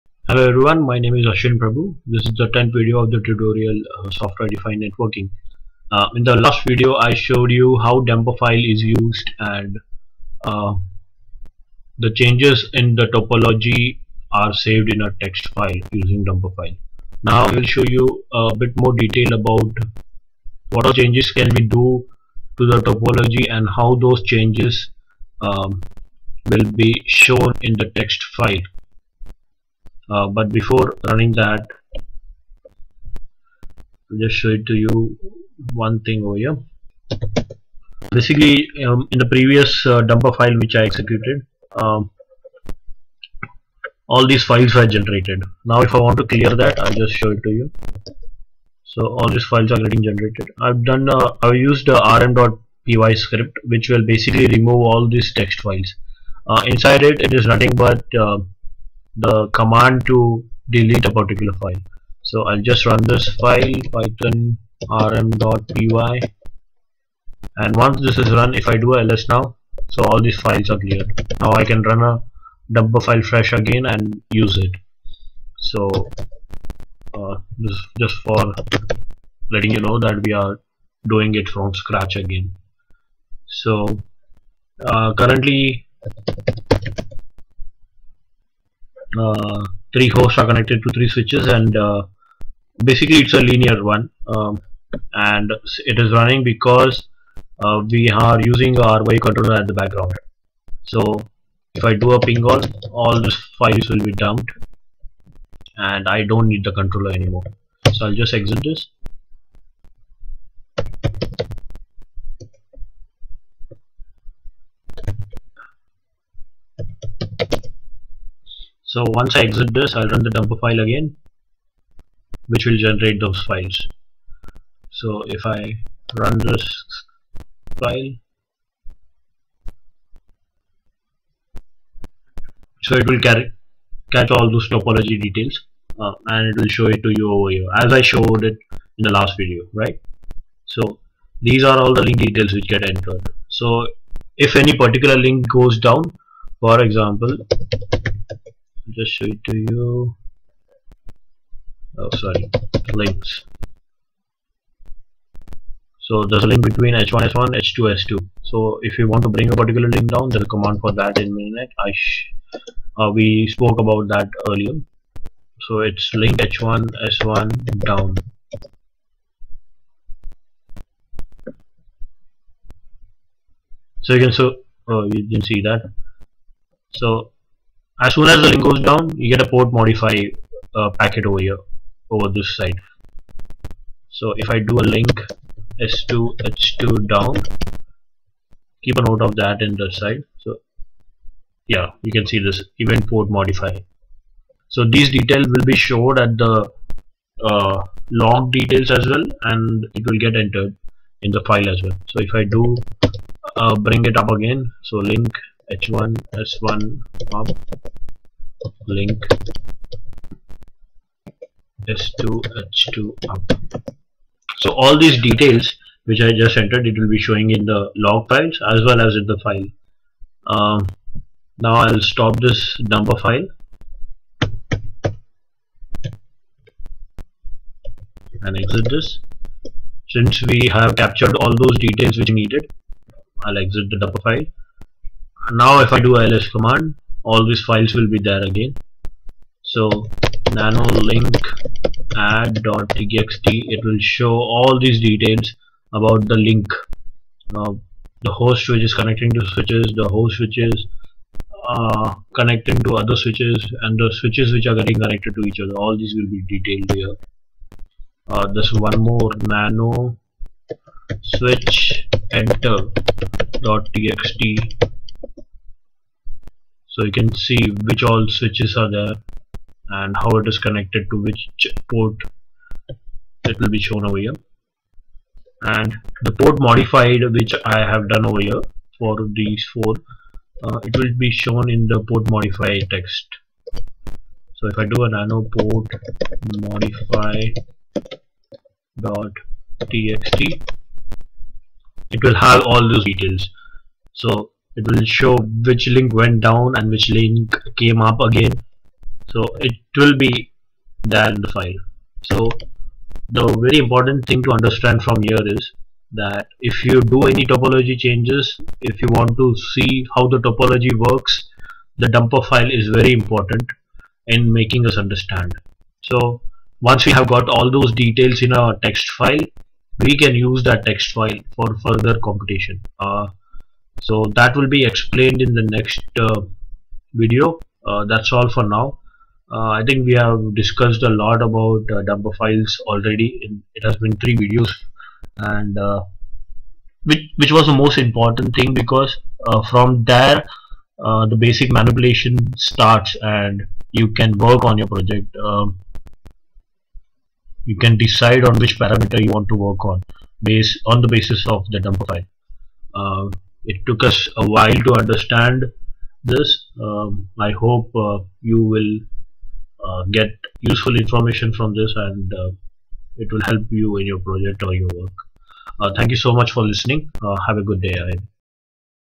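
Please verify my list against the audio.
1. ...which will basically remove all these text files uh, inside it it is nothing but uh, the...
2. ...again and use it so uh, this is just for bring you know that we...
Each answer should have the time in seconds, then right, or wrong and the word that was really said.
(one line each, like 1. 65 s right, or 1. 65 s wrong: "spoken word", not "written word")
1. 53 s right
2. 73 s wrong: "letting", not "bring".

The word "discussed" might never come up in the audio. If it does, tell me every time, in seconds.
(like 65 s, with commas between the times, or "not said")
330 s.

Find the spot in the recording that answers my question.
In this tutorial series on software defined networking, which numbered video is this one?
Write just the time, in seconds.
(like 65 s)
2 s.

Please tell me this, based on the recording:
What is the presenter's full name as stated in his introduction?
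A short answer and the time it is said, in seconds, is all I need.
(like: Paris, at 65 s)
Ashwin Prabhu, at 1 s.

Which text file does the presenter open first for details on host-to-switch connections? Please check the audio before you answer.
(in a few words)
link add.txt.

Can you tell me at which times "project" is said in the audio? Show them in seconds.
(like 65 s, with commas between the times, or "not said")
344 s, 364 s.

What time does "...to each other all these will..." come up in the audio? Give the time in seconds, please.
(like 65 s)
255 s.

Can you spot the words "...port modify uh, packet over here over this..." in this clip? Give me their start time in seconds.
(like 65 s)
179 s.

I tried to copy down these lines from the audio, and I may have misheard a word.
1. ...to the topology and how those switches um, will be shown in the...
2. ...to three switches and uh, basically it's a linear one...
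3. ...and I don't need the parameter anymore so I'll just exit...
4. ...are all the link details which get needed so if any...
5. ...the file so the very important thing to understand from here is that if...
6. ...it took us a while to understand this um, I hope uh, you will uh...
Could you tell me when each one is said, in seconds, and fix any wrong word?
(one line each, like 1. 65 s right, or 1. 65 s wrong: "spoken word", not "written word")
1. 22 s wrong: "changes", not "switches"
2. 90 s right
3. 105 s wrong: "controller", not "parameter"
4. 141 s wrong: "entered", not "needed"
5. 301 s right
6. 353 s right.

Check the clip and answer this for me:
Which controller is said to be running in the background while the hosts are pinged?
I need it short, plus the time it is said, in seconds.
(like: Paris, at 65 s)
RYU, at 98 s.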